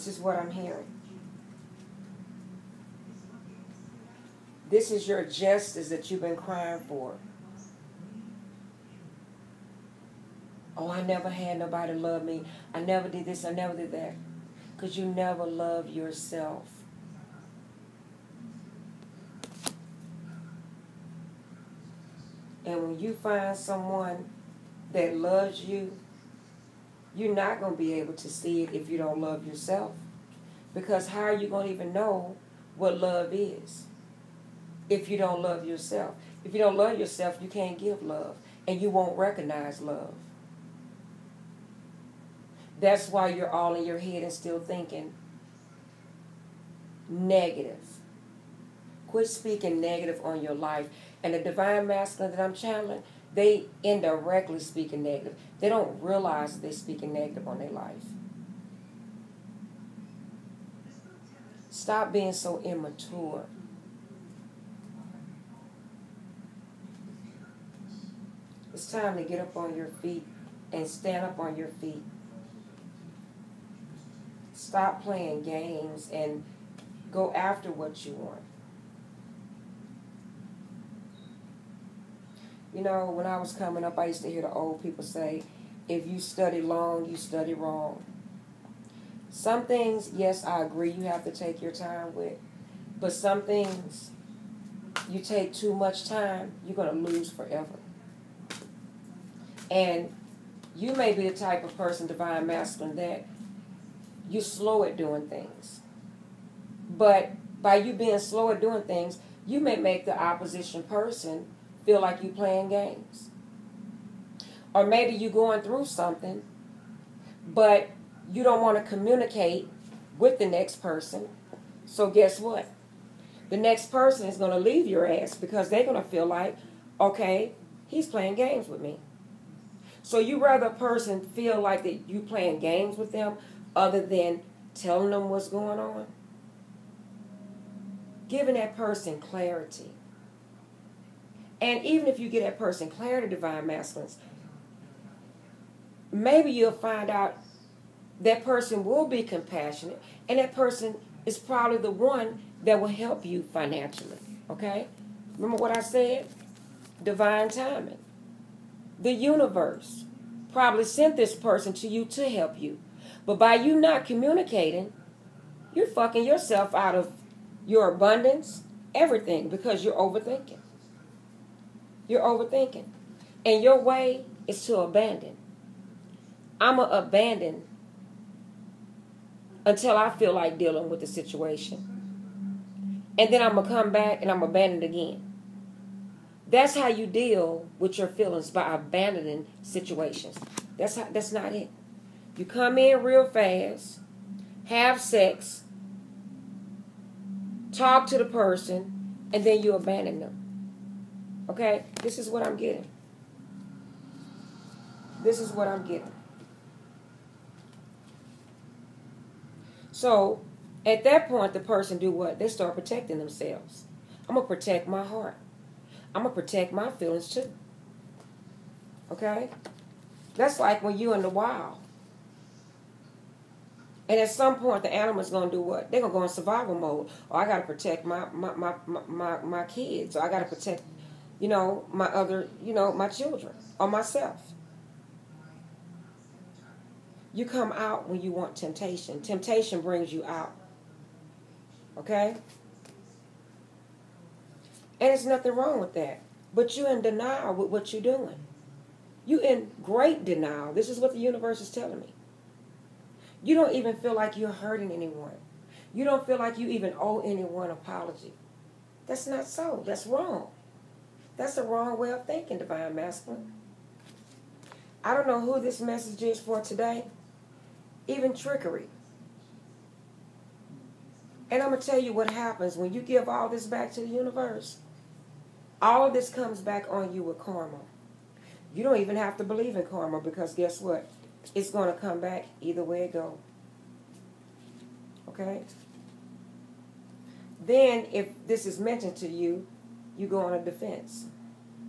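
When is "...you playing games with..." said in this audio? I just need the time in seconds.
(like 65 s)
132 s.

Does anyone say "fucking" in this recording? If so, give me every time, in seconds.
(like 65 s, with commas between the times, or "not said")
165 s.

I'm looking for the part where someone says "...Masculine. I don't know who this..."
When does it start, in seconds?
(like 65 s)
262 s.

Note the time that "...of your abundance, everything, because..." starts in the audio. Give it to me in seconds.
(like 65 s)
166 s.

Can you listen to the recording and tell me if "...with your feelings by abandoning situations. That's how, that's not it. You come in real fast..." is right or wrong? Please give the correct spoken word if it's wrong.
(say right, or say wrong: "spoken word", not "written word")
right.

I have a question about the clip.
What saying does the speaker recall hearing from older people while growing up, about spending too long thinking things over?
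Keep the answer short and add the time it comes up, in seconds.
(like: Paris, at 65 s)
If you study long, you study wrong, at 85 s.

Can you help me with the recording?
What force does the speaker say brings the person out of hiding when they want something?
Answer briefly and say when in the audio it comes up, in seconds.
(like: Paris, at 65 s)
Temptation, at 239 s.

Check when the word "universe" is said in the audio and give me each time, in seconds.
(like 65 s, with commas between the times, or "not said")
159 s, 251 s, 274 s.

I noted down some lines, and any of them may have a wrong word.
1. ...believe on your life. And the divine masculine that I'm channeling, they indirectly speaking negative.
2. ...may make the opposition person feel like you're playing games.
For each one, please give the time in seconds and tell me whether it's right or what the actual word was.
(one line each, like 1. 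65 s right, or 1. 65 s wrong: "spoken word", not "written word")
1. 49 s wrong: "negative", not "believe"
2. 109 s right.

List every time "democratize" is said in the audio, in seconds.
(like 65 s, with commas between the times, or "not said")
not said.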